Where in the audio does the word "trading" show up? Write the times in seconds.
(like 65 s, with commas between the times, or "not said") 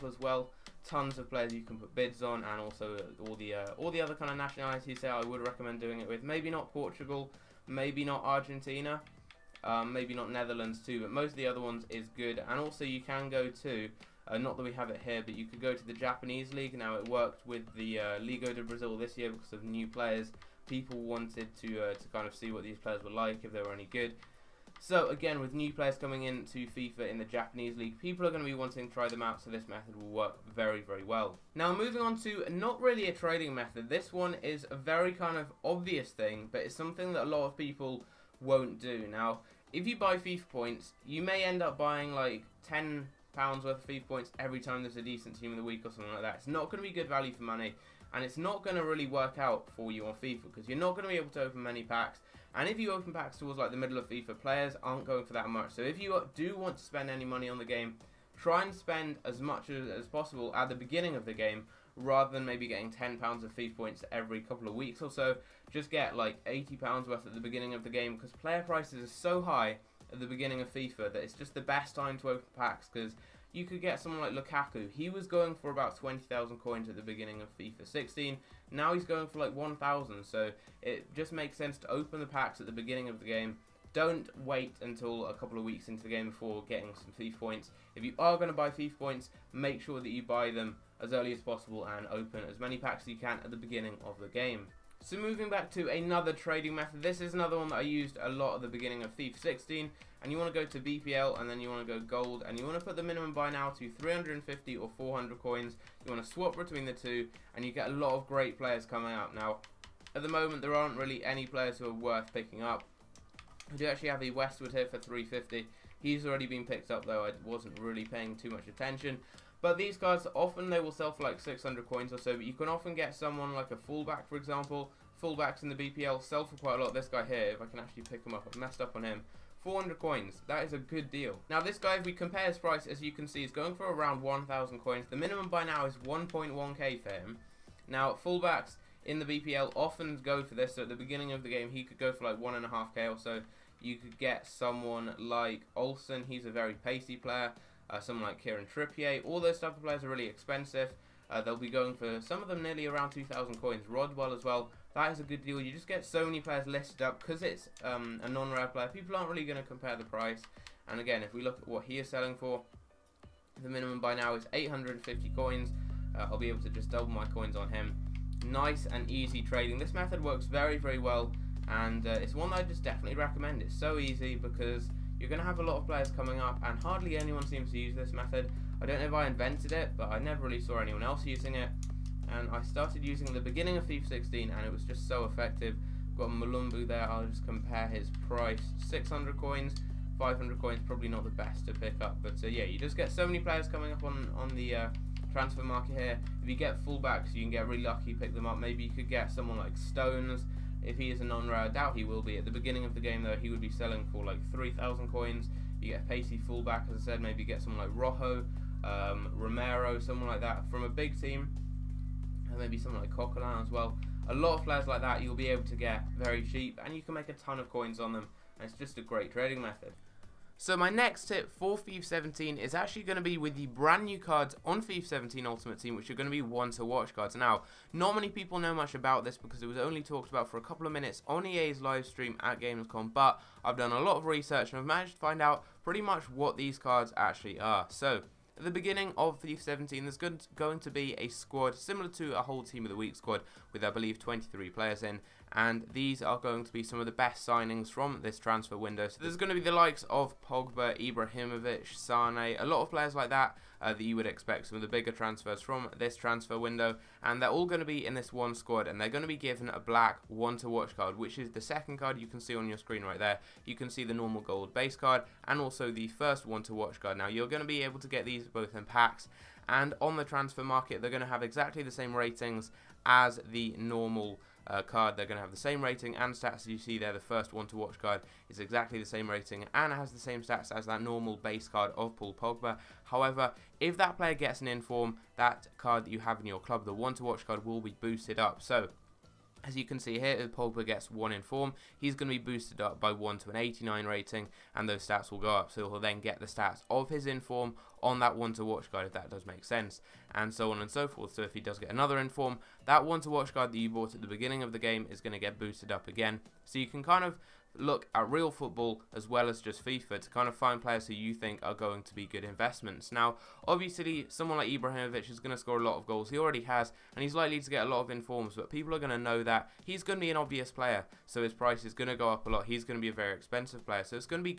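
33 s, 96 s, 169 s, 219 s.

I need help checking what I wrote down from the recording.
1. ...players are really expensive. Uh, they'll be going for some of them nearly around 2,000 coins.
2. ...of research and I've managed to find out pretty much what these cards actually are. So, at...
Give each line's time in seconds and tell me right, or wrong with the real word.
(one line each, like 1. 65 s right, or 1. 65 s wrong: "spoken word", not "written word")
1. 149 s right
2. 234 s right.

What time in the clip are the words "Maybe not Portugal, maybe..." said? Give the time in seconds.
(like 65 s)
6 s.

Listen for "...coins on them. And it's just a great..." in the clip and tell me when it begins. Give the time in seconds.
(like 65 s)
217 s.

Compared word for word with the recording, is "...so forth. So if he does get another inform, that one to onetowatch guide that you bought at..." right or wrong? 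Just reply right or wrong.
wrong.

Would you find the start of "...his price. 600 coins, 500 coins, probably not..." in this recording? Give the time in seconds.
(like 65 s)
187 s.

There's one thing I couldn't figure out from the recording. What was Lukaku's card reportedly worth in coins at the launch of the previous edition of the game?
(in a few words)
20,000 coins.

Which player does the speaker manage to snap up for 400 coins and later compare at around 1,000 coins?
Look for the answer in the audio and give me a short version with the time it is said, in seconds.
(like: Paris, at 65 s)
Westwood, at 114 s.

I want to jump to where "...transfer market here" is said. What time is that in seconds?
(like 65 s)
195 s.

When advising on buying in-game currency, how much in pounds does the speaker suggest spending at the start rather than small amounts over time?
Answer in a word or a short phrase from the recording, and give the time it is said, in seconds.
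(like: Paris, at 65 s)
£80, at 66 s.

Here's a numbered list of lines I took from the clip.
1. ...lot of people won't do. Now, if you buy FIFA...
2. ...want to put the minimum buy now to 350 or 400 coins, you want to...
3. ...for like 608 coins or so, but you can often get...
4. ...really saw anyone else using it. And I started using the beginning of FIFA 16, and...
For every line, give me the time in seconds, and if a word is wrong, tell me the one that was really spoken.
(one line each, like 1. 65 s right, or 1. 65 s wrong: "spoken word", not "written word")
1. 37 s right
2. 102 s right
3. 121 s wrong: "600", not "608"
4. 180 s right.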